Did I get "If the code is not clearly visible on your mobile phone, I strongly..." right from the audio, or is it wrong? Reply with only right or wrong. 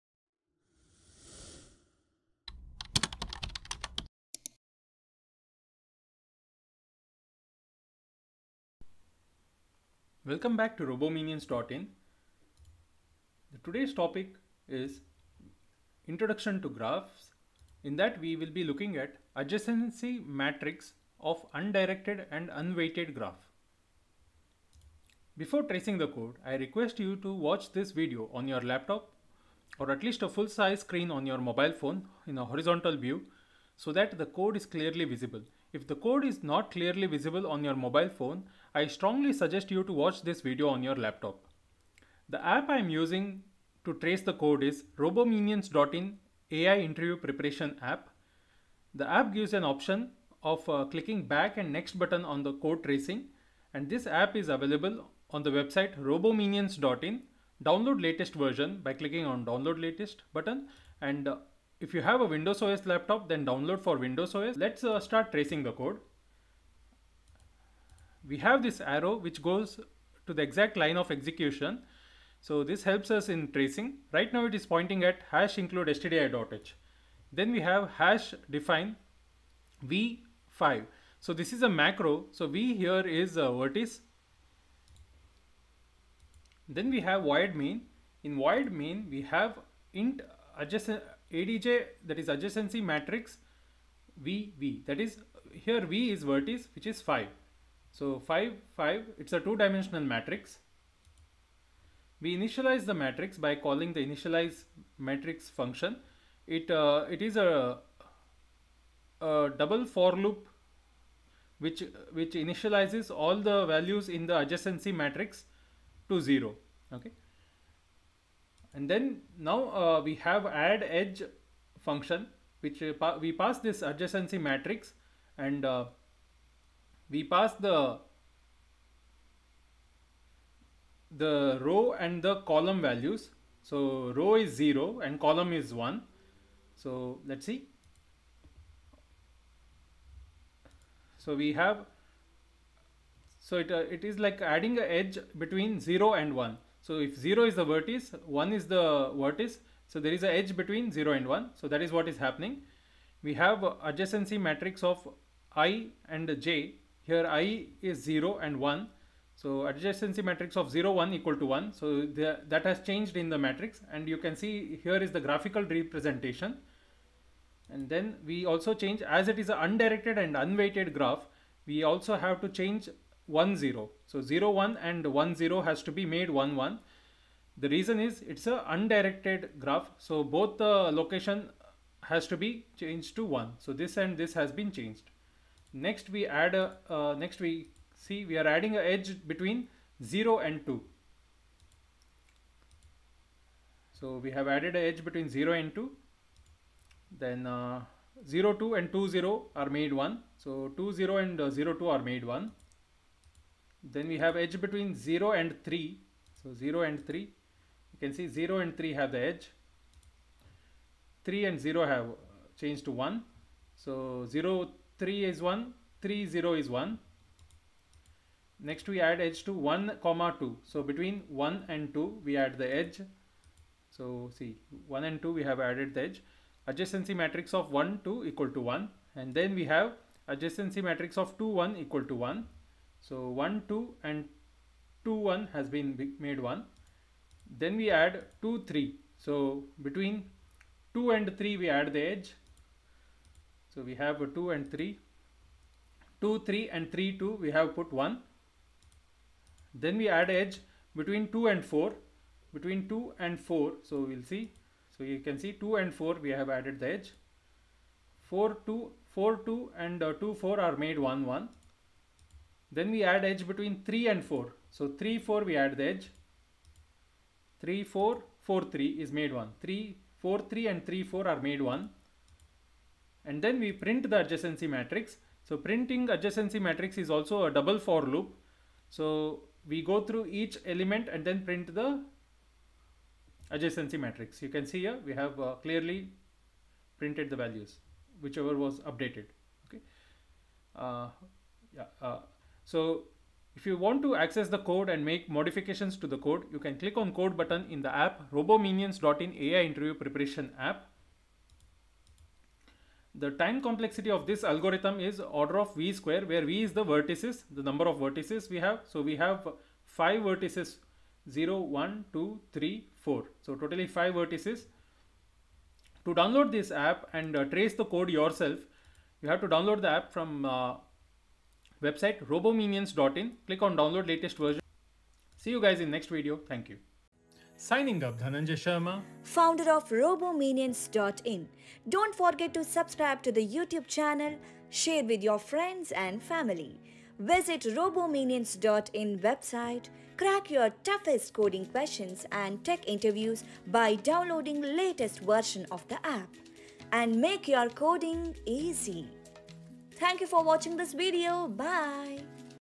right.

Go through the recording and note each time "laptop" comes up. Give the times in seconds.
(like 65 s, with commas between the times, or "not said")
28 s, 41 s, 62 s.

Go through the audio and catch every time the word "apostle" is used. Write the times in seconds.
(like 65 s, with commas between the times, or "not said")
not said.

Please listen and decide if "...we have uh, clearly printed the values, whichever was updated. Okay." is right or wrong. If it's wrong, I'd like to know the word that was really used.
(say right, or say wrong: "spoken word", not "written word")
right.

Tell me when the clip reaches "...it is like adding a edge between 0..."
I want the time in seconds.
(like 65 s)
143 s.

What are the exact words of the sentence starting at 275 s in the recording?
So printing adjacency matrix is also a double for loop.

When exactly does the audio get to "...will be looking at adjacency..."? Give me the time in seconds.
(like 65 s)
18 s.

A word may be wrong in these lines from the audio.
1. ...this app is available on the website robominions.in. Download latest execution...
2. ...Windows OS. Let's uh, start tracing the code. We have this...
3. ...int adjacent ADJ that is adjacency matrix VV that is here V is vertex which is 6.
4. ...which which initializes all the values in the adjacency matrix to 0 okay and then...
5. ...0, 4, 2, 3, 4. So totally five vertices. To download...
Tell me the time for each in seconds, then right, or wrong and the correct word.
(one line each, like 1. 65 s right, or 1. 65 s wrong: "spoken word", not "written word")
1. 53 s wrong: "version", not "execution"
2. 63 s right
3. 89 s wrong: "5", not "6"
4. 111 s right
5. 311 s wrong: "1", not "4".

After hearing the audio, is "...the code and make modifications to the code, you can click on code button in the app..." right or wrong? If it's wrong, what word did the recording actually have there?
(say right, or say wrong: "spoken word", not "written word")
right.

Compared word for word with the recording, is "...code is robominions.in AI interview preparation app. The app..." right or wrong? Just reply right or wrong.
right.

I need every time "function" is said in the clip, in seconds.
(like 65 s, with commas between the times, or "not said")
105 s, 121 s.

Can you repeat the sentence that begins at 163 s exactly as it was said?
And you can see here is the graphical representation.